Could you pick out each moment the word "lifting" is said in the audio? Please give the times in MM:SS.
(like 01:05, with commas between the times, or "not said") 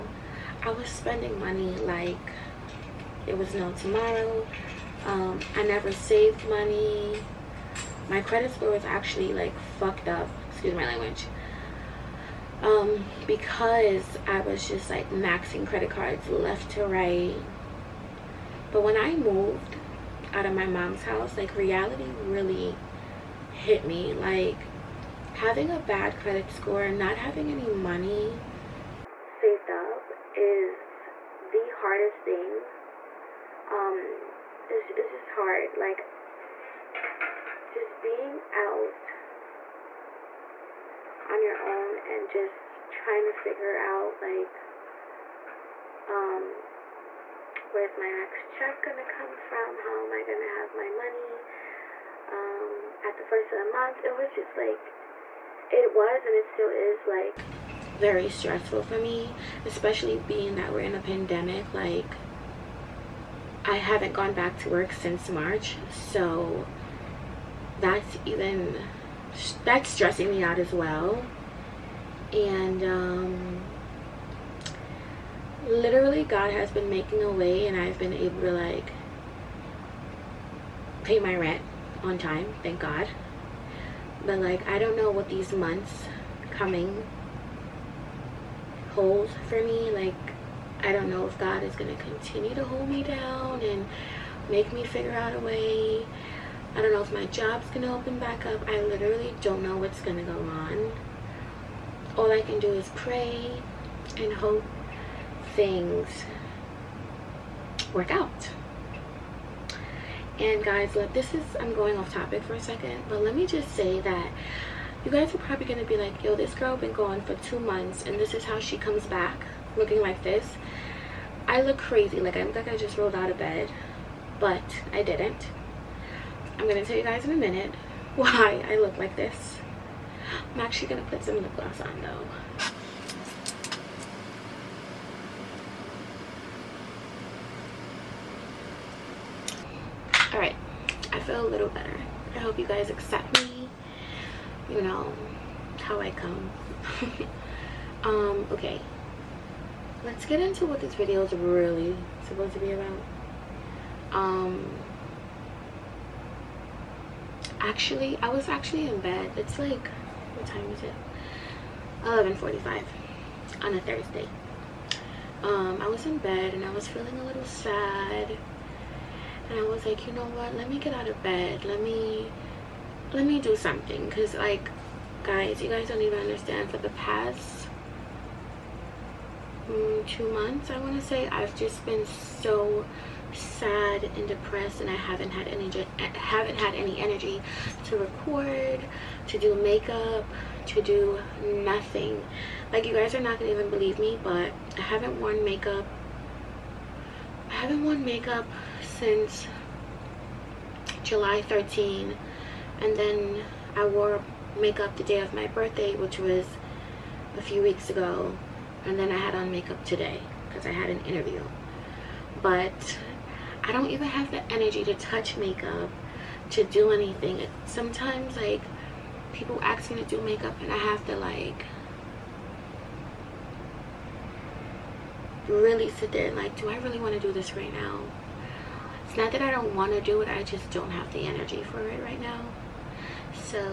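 not said.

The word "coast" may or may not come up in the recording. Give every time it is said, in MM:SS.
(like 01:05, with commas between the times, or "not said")
not said.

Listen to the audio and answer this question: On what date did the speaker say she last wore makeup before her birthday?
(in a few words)
July 13.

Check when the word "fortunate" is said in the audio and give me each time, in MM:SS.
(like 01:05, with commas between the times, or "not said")
not said.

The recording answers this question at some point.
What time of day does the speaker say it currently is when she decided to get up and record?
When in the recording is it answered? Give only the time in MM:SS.
02:42.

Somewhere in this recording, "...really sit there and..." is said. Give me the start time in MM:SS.
03:45.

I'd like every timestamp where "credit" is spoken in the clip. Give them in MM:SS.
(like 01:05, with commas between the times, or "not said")
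00:08, 00:15, 00:26.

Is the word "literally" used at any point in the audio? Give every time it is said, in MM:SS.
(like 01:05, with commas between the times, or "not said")
01:15, 01:38.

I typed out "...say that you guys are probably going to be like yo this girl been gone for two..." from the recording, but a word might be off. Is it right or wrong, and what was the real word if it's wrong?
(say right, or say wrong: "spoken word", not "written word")
right.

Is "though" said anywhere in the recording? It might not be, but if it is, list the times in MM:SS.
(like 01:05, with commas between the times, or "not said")
02:12.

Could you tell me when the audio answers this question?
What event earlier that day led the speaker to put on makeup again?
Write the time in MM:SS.
03:30.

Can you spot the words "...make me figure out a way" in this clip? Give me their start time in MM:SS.
01:34.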